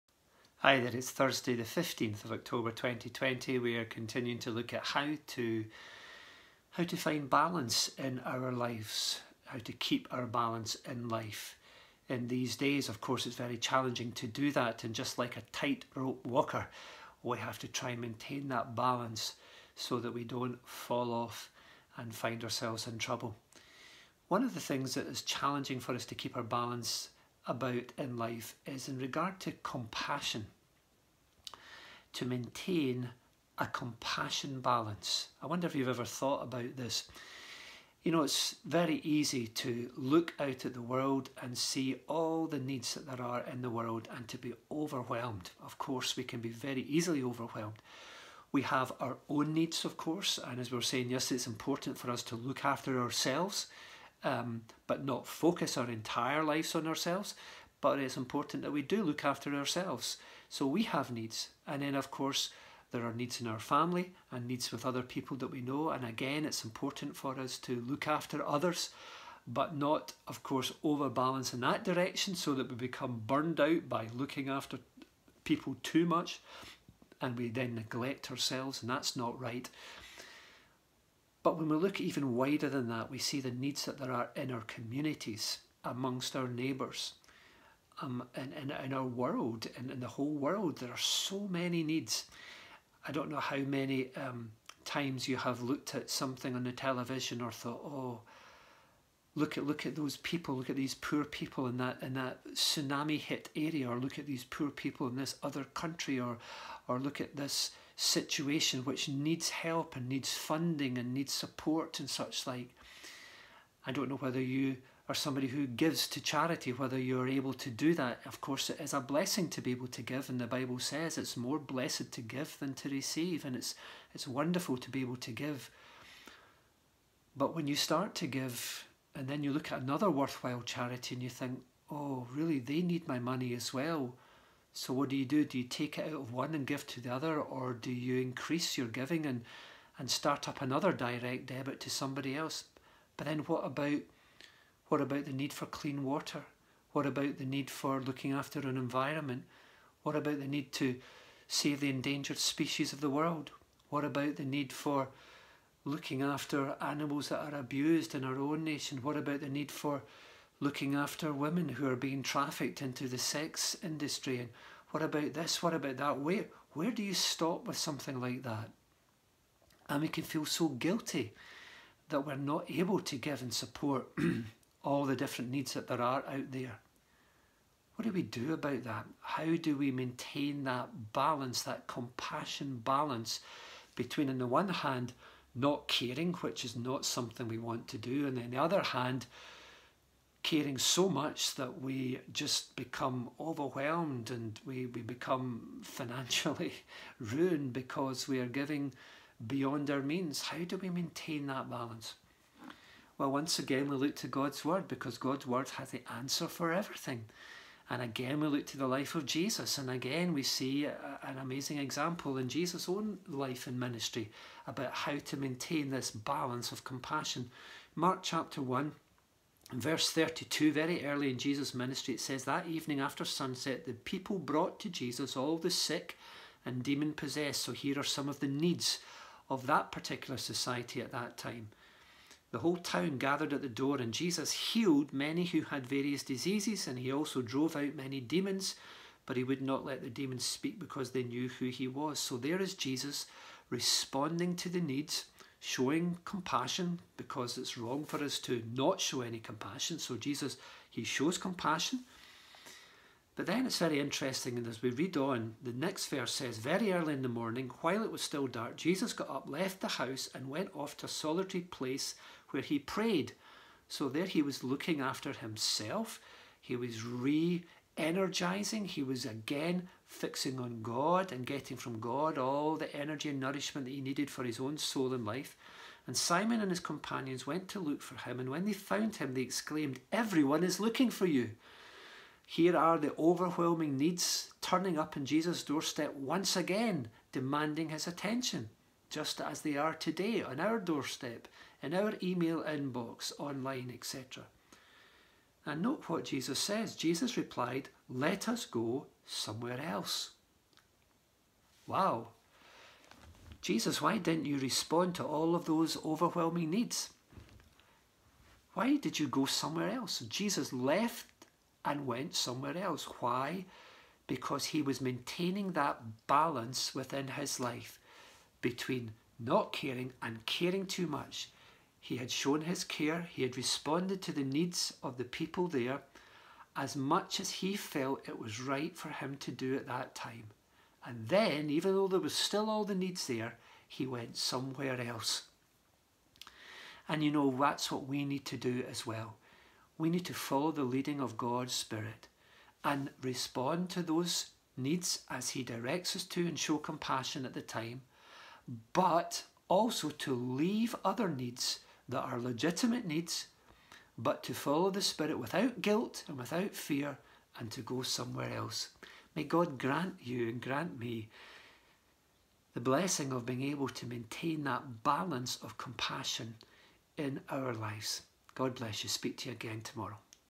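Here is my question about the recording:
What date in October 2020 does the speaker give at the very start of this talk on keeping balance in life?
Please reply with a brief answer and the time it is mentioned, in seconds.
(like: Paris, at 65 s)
Thursday the 15th, at 1 s.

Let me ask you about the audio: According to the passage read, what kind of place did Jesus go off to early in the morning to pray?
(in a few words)
solitary place.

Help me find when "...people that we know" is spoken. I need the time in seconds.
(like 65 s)
65 s.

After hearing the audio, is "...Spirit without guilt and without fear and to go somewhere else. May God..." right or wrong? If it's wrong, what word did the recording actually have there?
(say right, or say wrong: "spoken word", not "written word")
right.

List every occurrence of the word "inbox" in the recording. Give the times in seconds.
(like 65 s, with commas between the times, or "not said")
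292 s.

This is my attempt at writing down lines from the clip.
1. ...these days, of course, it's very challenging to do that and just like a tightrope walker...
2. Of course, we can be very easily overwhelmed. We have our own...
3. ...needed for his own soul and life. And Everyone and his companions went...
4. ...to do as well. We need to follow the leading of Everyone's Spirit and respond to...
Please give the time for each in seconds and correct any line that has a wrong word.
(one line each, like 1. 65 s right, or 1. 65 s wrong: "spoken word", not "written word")
1. 12 s right
2. 45 s right
3. 274 s wrong: "Simon", not "Everyone"
4. 338 s wrong: "God", not "Everyone".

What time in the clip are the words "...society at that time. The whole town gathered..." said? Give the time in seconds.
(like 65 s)
230 s.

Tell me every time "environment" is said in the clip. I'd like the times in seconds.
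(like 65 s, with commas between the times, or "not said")
148 s.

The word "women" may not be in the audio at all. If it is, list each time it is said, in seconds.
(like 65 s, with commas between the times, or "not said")
161 s.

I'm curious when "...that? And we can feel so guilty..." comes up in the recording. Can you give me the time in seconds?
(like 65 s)
168 s.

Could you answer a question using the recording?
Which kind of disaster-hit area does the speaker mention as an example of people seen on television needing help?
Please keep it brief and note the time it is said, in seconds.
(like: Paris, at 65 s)
tsunami, at 102 s.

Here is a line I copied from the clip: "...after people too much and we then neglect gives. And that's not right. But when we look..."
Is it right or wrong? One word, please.
wrong.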